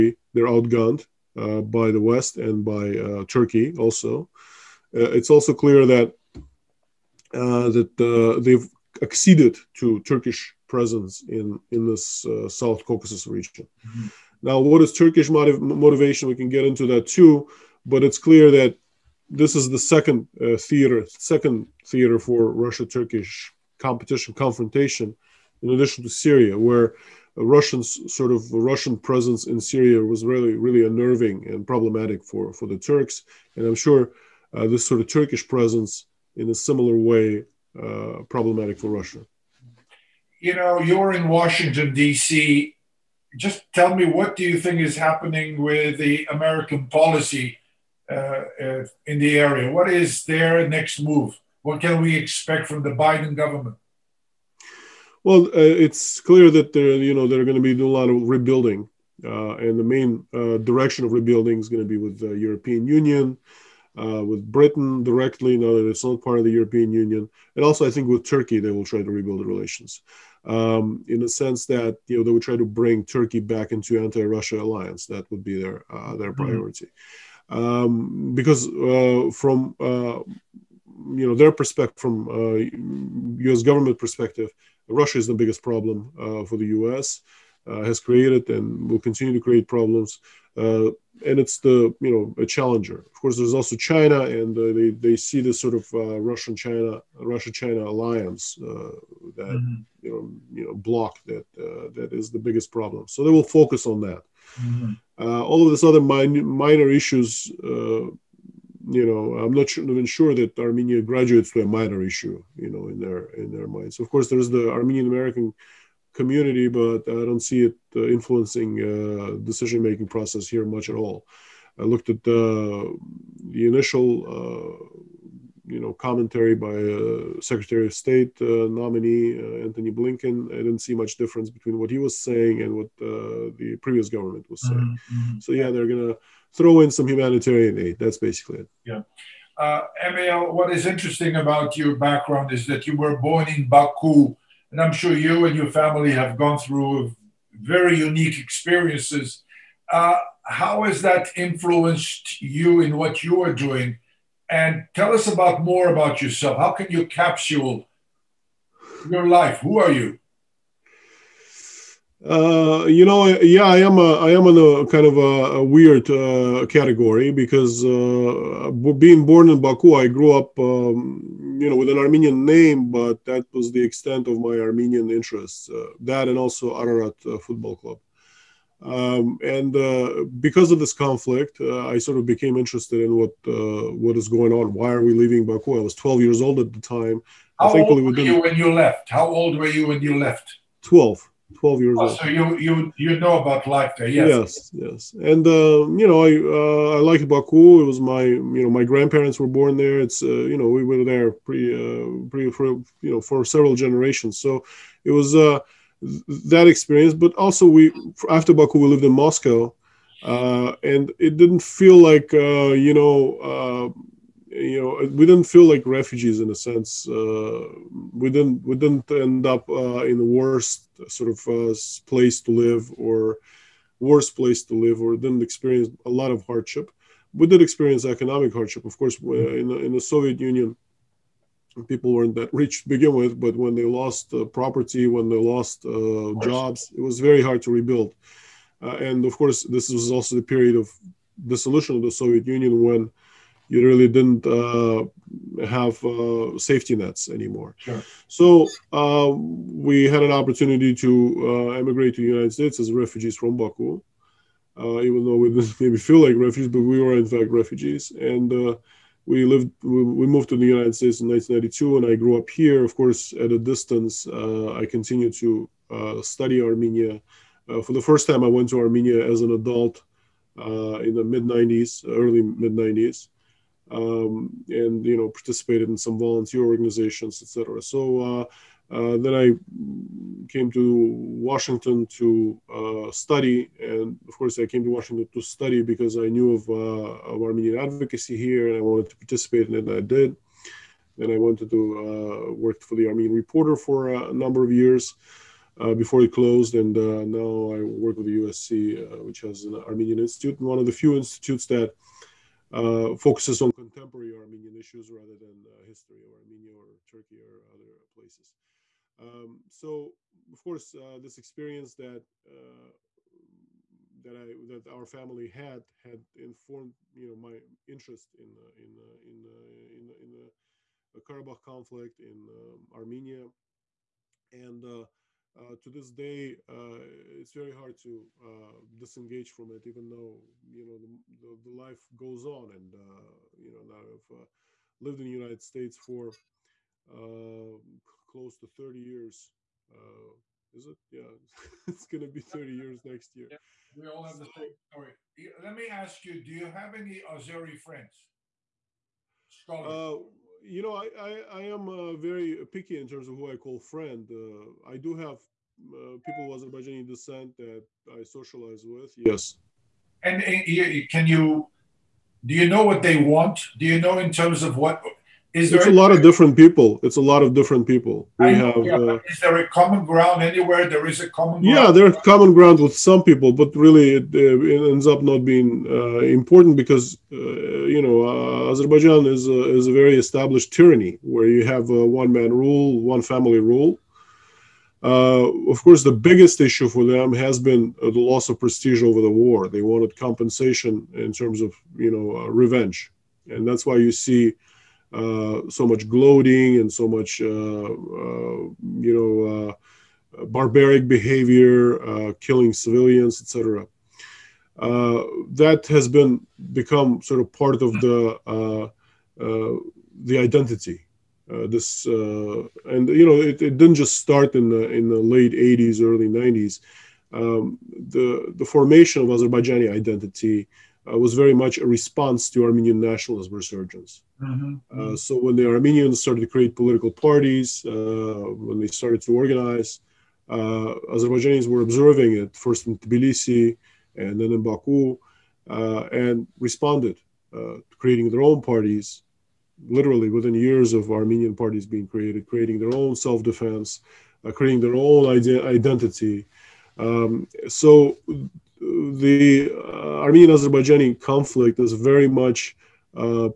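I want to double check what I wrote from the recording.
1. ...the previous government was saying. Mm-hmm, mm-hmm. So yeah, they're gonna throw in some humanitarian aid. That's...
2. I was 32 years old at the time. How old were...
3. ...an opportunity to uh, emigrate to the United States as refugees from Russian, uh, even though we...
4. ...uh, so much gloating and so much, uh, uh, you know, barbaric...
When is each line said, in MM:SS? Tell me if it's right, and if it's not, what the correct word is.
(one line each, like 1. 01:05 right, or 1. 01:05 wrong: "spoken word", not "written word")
1. 02:12 right
2. 03:05 wrong: "12", not "32"
3. 04:10 wrong: "Baku", not "Russian"
4. 06:35 right.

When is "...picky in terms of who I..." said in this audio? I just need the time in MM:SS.
05:52.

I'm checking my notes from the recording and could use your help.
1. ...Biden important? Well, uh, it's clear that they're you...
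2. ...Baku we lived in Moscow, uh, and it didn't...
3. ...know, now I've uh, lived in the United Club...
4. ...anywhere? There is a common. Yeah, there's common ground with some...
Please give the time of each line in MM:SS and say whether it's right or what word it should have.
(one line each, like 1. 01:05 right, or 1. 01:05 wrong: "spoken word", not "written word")
1. 00:52 wrong: "government", not "important"
2. 03:28 right
3. 05:33 wrong: "States", not "Club"
4. 06:10 right.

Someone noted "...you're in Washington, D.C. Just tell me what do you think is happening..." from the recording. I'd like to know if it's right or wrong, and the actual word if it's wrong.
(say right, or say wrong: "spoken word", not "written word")
right.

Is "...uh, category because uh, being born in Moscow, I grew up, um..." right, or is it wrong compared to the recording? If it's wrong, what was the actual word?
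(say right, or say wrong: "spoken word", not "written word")
wrong: "Baku", not "Moscow".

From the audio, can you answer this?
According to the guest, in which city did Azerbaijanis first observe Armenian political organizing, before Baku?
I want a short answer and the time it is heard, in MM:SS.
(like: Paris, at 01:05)
Tbilisi, at 07:12.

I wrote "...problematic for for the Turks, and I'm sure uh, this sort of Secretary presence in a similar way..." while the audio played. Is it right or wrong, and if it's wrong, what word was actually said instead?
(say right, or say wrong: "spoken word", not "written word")
wrong: "Turkish", not "Secretary".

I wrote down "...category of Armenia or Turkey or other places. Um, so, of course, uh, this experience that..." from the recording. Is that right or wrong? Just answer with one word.
wrong.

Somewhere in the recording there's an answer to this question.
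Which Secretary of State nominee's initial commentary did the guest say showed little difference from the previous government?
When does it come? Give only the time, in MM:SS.
02:09.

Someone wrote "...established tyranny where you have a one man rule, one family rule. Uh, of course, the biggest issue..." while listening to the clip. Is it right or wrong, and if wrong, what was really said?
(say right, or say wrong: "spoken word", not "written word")
right.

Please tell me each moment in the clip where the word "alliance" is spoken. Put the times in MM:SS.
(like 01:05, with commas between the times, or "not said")
01:14, 01:37.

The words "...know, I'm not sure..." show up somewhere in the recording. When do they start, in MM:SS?
01:49.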